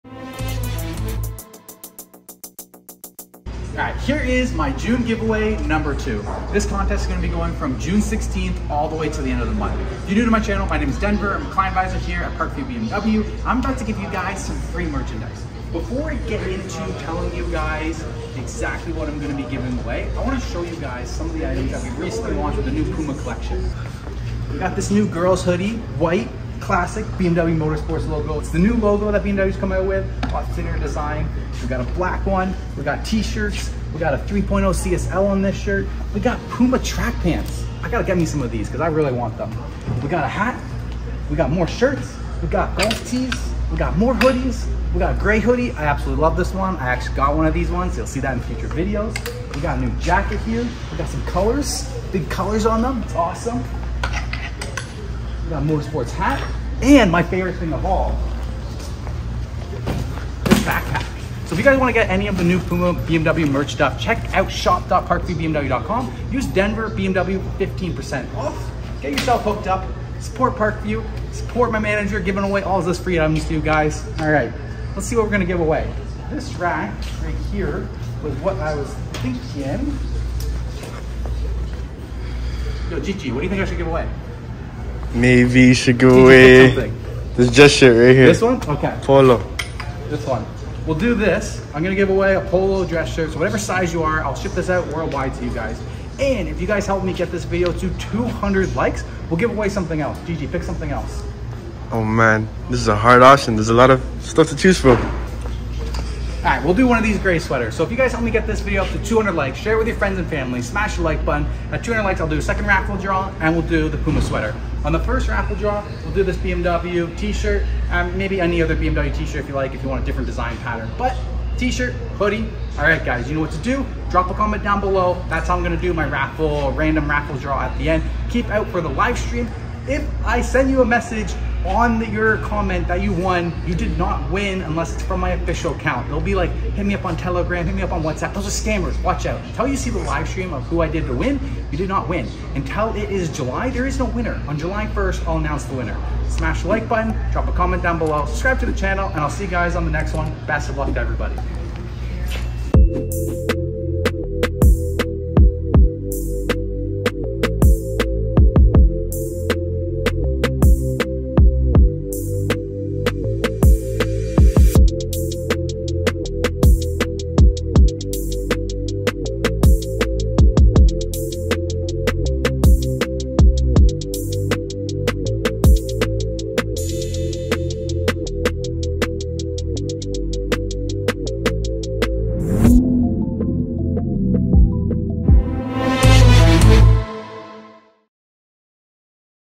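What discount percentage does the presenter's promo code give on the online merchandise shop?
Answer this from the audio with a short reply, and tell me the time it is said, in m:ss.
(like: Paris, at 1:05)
15%, at 1:07.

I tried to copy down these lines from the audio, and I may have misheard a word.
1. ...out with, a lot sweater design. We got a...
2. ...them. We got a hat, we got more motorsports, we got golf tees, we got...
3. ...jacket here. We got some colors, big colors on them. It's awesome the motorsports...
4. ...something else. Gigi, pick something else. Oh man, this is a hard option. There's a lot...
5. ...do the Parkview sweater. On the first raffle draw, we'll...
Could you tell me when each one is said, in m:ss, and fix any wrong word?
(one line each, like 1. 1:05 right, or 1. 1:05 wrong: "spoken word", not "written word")
1. 0:29 wrong: "thinner", not "sweater"
2. 0:39 wrong: "shirts", not "motorsports"
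3. 0:49 right
4. 1:39 right
5. 1:53 wrong: "Puma", not "Parkview".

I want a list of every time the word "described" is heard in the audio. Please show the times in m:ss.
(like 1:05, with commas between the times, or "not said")
not said.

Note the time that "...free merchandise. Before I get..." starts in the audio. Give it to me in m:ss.
0:14.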